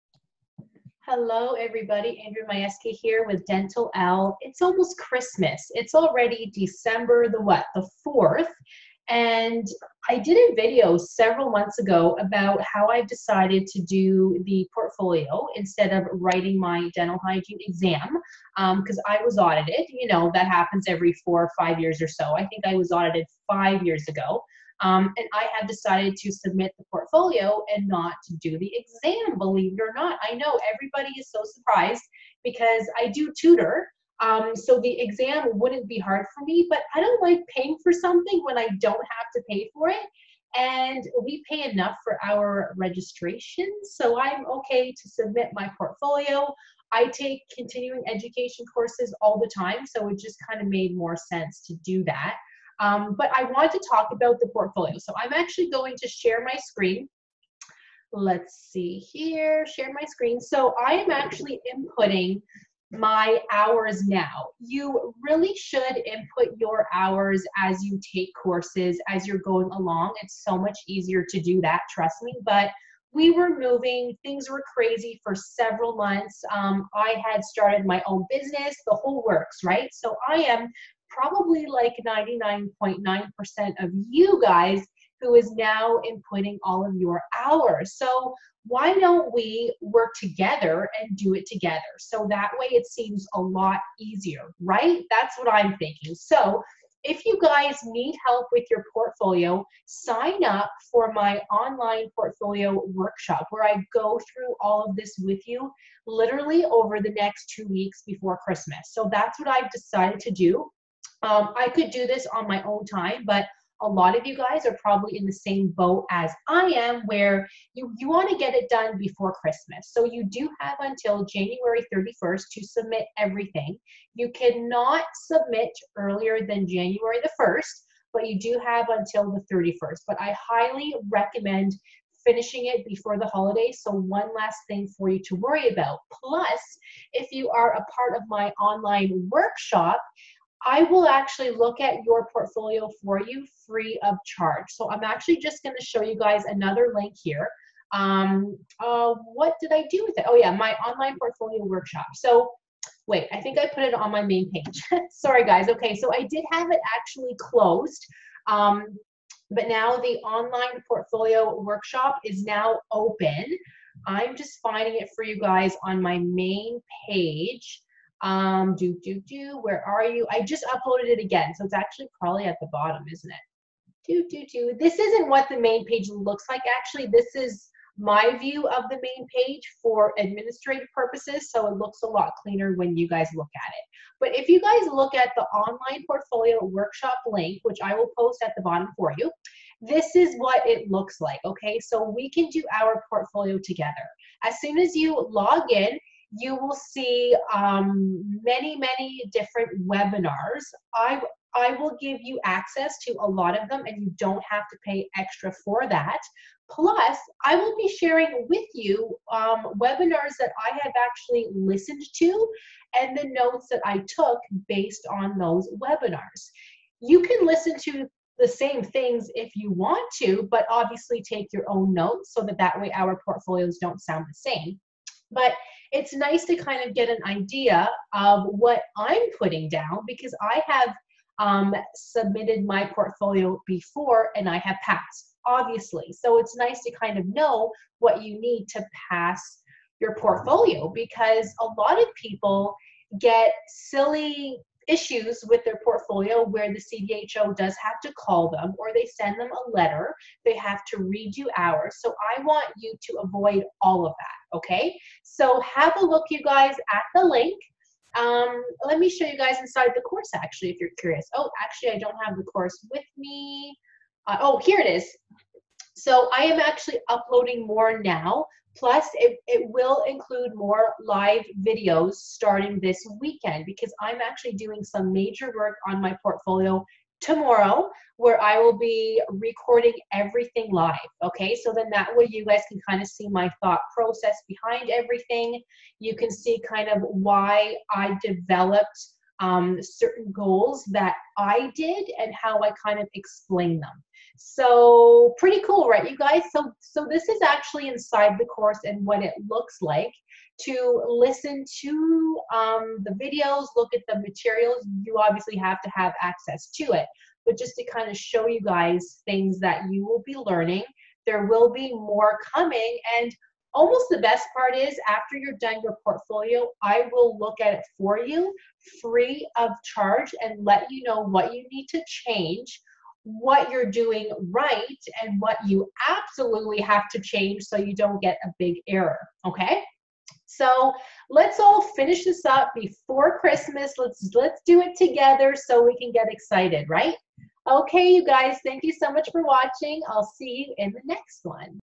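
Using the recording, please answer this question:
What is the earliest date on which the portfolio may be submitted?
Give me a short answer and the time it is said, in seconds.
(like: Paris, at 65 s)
January 1st, at 126 s.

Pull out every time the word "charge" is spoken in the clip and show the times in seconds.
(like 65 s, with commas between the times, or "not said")
144 s, 319 s.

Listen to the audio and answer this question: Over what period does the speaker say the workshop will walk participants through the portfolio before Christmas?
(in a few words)
2 weeks.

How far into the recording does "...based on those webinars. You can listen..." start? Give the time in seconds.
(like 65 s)
214 s.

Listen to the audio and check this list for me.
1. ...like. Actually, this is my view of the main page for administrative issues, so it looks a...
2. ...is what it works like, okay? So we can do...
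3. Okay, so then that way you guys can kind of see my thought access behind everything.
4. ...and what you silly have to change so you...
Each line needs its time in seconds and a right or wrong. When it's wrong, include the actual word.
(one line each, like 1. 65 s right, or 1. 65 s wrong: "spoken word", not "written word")
1. 176 s wrong: "purposes", not "issues"
2. 190 s wrong: "looks", not "works"
3. 281 s wrong: "process", not "access"
4. 325 s wrong: "absolutely", not "silly".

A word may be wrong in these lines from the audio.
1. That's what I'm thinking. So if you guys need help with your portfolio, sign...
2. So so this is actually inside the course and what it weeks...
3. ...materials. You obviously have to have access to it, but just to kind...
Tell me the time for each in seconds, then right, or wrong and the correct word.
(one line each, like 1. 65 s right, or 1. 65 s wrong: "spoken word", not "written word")
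1. 95 s right
2. 296 s wrong: "looks", not "weeks"
3. 304 s right.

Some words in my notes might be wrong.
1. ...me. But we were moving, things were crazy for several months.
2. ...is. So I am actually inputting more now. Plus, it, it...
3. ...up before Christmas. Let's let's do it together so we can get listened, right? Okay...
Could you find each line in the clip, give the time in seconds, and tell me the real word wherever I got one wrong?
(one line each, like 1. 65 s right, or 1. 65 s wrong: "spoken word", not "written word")
1. 72 s right
2. 264 s wrong: "uploading", not "inputting"
3. 332 s wrong: "excited", not "listened".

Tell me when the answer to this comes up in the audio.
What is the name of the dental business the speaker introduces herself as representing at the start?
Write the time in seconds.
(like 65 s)
3 s.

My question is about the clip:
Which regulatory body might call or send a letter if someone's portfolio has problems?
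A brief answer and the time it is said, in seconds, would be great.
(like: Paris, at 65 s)
CDHO, at 246 s.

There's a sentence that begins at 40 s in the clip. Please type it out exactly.
And we pay enough for our registration, so I'm okay to submit my portfolio.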